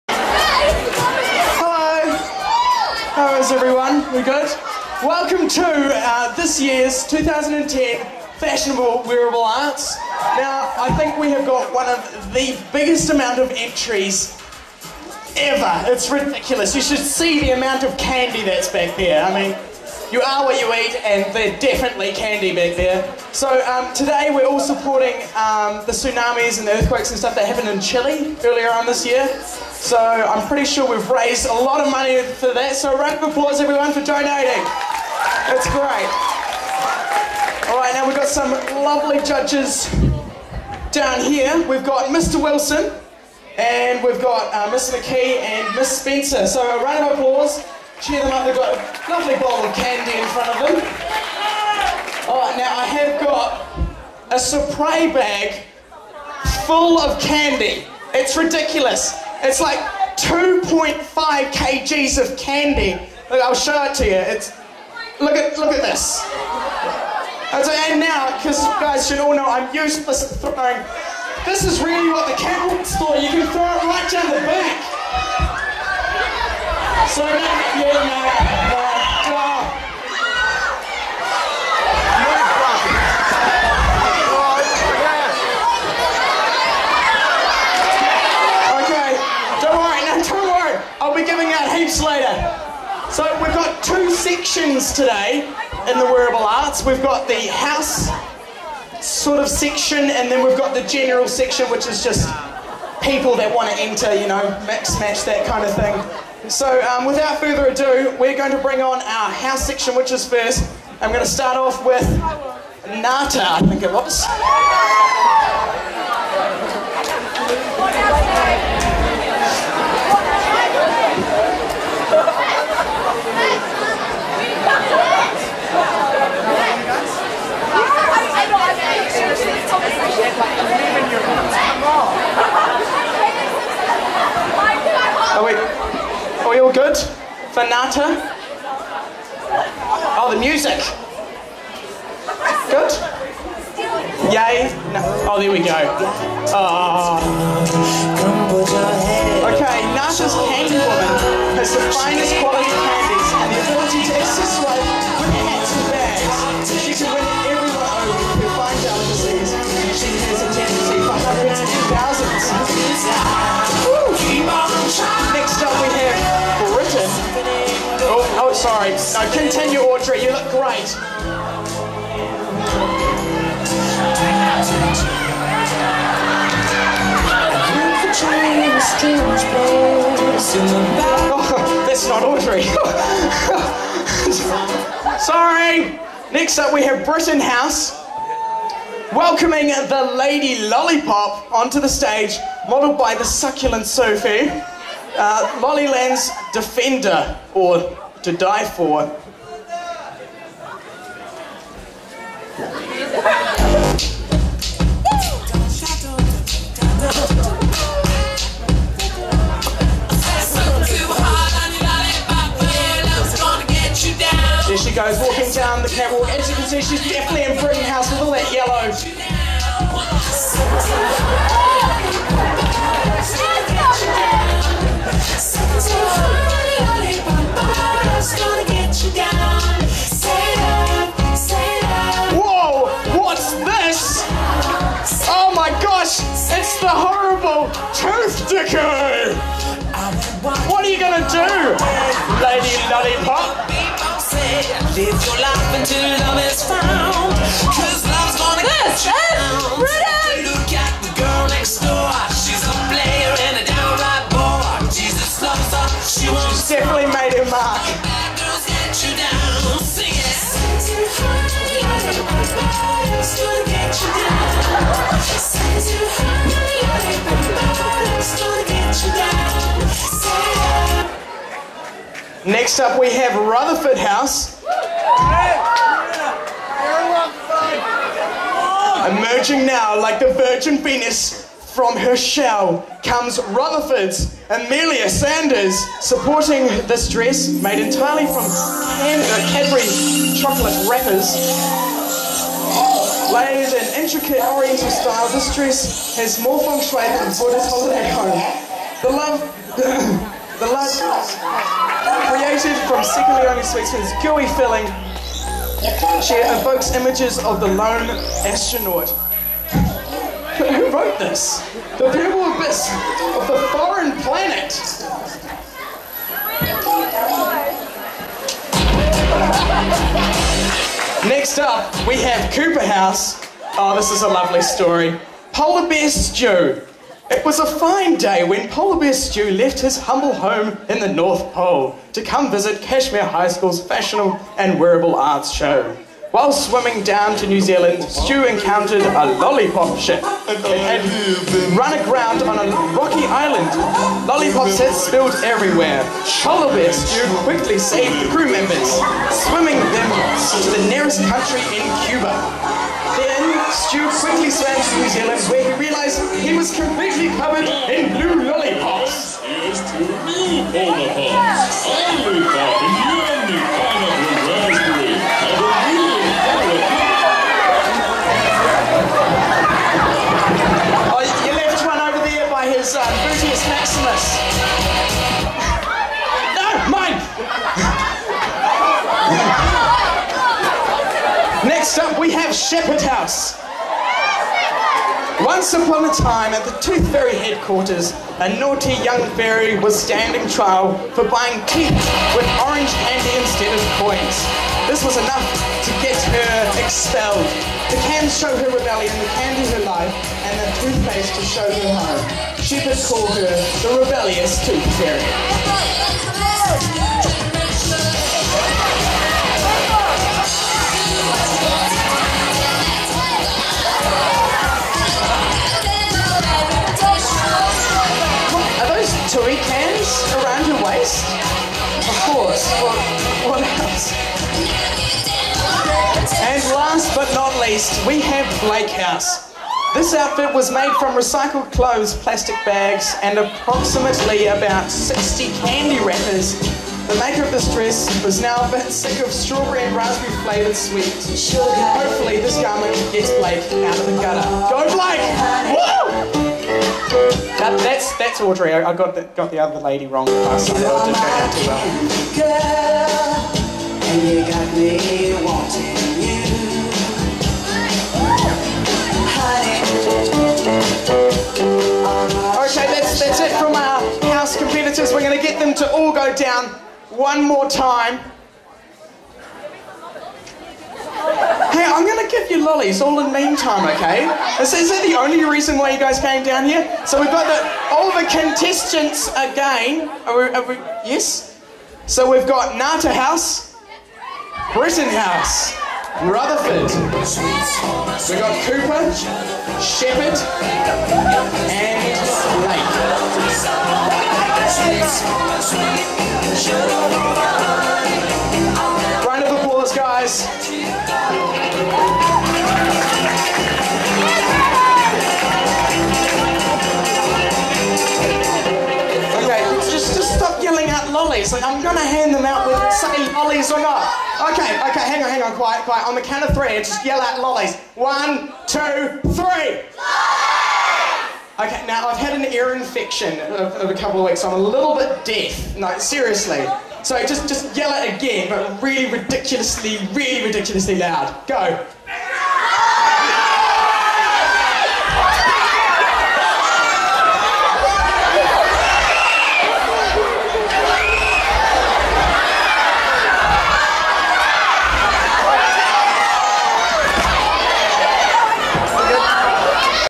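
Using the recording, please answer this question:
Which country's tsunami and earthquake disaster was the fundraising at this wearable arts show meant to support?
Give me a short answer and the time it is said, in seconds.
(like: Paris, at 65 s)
Chile, at 27 s.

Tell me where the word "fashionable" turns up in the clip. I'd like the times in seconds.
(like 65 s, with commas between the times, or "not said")
8 s, 333 s.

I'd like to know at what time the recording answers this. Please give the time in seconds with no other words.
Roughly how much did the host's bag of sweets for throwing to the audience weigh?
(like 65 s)
60 s.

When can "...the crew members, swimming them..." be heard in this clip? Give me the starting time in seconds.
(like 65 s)
348 s.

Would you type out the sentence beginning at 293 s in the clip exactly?
Layered in intricate oriental style, this dress has more feng shui than Buddha's holiday home.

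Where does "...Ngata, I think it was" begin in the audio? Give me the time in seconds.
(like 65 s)
112 s.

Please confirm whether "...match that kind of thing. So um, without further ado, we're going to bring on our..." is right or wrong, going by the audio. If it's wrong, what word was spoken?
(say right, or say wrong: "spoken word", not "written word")
right.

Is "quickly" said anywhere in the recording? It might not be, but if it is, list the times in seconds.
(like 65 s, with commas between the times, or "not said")
347 s, 354 s.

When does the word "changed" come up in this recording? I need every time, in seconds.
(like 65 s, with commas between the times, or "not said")
not said.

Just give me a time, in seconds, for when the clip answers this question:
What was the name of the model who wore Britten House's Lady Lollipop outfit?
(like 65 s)
193 s.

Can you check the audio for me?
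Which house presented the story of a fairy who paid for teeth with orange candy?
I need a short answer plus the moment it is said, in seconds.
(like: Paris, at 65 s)
Sheppard House, at 382 s.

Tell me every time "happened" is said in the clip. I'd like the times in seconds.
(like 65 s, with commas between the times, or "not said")
27 s.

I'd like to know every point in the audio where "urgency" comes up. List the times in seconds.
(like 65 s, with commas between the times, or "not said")
not said.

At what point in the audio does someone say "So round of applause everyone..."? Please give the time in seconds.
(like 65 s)
32 s.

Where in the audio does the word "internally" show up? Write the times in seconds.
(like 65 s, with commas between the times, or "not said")
not said.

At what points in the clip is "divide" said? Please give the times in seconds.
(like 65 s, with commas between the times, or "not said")
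not said.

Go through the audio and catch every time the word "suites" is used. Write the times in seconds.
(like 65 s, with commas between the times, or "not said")
not said.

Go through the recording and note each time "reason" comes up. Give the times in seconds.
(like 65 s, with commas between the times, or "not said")
475 s.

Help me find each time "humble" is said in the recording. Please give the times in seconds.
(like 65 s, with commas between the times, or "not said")
329 s.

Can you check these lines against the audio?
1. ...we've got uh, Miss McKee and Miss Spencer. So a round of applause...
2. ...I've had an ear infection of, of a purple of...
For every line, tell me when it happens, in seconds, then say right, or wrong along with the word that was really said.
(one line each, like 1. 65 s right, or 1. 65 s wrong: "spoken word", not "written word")
1. 44 s right
2. 522 s wrong: "couple", not "purple".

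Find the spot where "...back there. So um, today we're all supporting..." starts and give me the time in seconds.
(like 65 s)
22 s.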